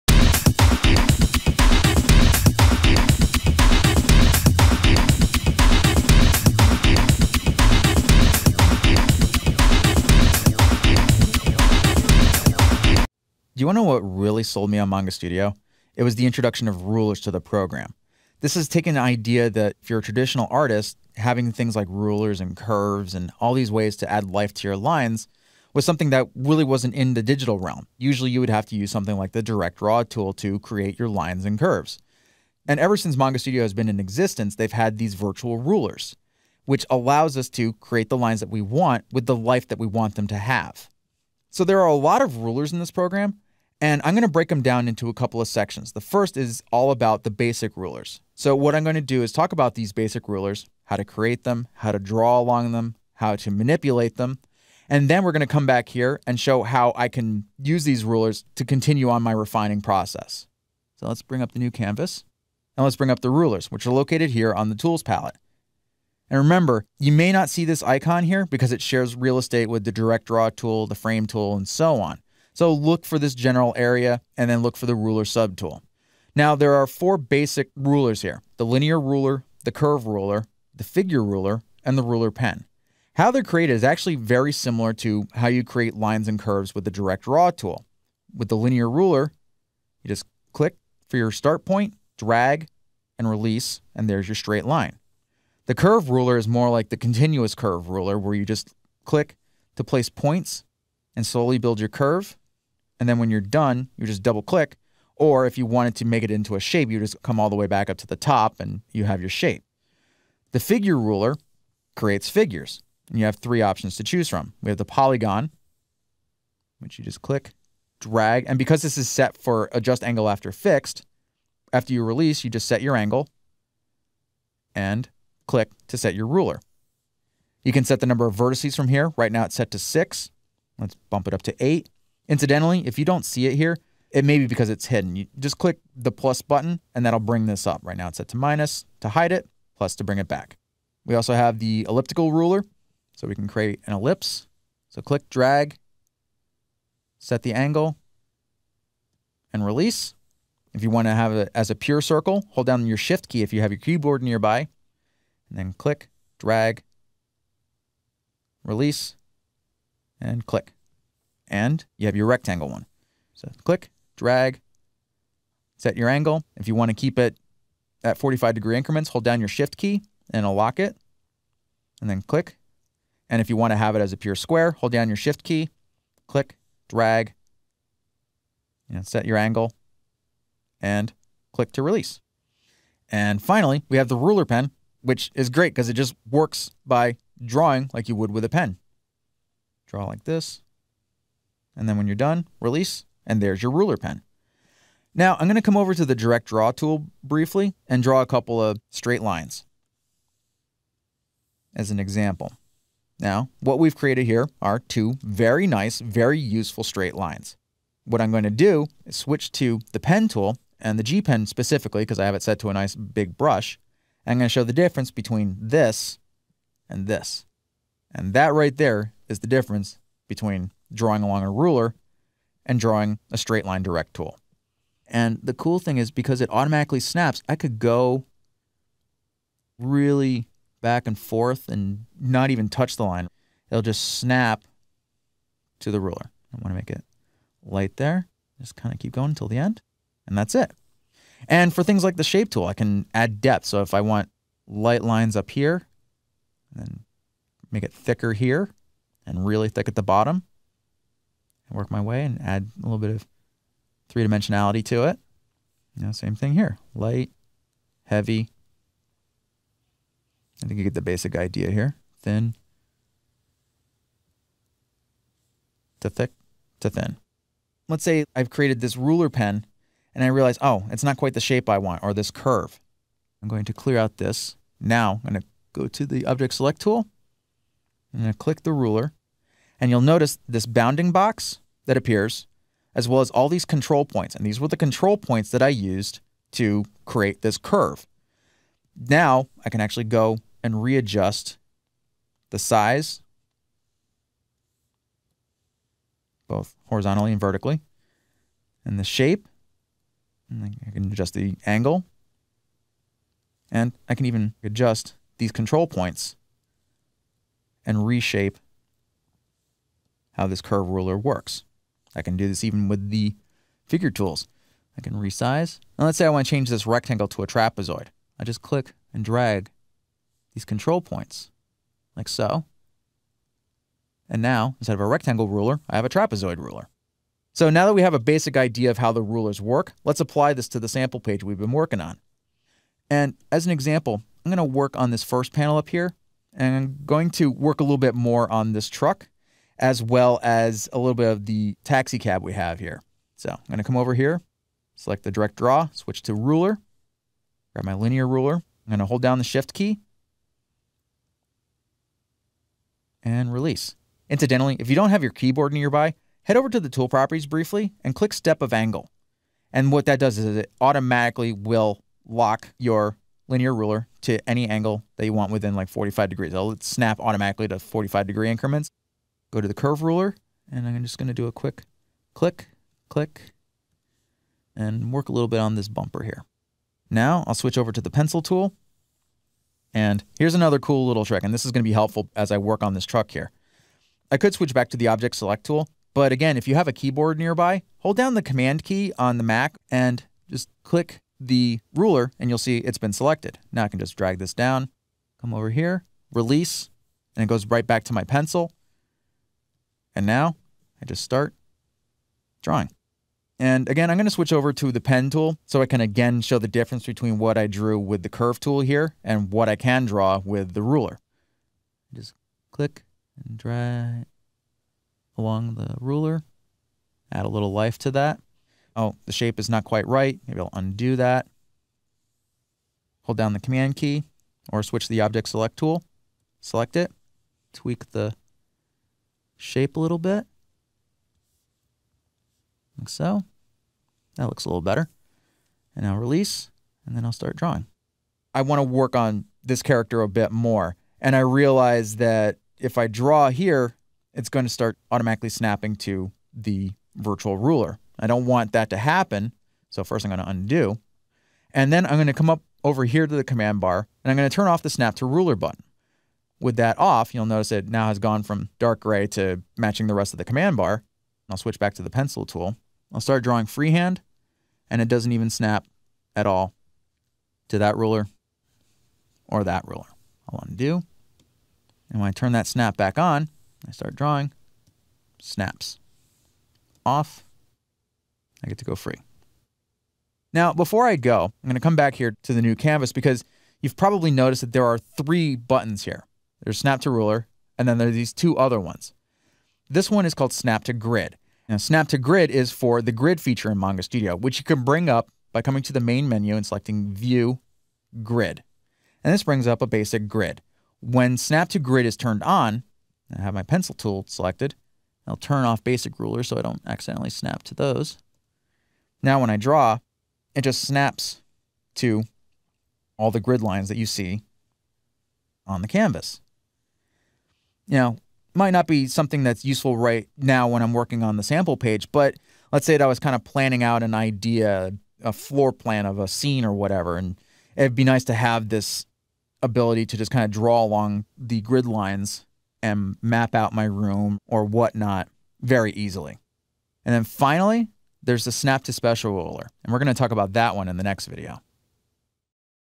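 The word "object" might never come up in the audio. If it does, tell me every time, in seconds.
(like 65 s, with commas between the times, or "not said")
276 s, 385 s, 425 s.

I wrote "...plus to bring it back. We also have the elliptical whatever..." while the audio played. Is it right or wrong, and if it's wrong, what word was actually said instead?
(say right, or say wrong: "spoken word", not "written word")
wrong: "ruler", not "whatever".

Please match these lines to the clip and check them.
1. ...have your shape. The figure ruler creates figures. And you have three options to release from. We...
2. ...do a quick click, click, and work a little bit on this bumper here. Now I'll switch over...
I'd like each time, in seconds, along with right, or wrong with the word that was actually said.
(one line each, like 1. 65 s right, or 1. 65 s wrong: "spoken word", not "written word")
1. 109 s wrong: "choose", not "release"
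2. 371 s right.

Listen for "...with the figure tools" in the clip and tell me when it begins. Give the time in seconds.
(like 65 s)
312 s.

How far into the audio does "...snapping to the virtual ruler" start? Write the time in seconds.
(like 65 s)
445 s.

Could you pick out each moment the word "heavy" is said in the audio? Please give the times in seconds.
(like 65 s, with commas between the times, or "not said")
258 s.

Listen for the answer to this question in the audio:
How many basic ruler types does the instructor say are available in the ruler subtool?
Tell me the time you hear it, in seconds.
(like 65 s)
76 s.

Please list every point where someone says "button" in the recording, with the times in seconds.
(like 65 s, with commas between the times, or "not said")
136 s, 455 s, 485 s.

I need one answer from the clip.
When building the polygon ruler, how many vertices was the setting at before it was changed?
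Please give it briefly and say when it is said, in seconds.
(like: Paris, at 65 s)
6, at 129 s.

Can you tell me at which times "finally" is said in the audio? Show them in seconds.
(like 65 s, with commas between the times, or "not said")
183 s, 537 s.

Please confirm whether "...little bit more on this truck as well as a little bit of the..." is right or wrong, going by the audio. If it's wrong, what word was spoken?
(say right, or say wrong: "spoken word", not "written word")
right.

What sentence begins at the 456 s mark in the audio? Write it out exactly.
With that off, you'll notice it now has gone from dark gray to matching the rest of the command bar.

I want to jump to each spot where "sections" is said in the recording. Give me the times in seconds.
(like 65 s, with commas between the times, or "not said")
45 s.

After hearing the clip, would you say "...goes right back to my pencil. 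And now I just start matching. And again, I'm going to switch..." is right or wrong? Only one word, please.
wrong.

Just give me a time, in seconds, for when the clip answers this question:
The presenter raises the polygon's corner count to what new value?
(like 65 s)
131 s.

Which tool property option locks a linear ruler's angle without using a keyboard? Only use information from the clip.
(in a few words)
step of angle.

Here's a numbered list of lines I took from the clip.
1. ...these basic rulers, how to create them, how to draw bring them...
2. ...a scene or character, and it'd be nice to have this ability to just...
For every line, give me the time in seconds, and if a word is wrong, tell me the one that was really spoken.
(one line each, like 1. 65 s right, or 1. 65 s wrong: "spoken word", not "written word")
1. 49 s wrong: "along", not "bring"
2. 526 s wrong: "whatever", not "character".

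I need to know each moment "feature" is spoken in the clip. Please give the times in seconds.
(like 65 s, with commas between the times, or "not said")
493 s.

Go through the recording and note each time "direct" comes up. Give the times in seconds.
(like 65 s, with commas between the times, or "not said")
29 s, 69 s, 86 s, 196 s, 223 s, 345 s.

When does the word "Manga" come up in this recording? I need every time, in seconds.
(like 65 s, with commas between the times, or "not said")
14 s, 33 s, 493 s.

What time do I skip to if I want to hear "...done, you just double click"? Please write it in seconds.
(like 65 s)
103 s.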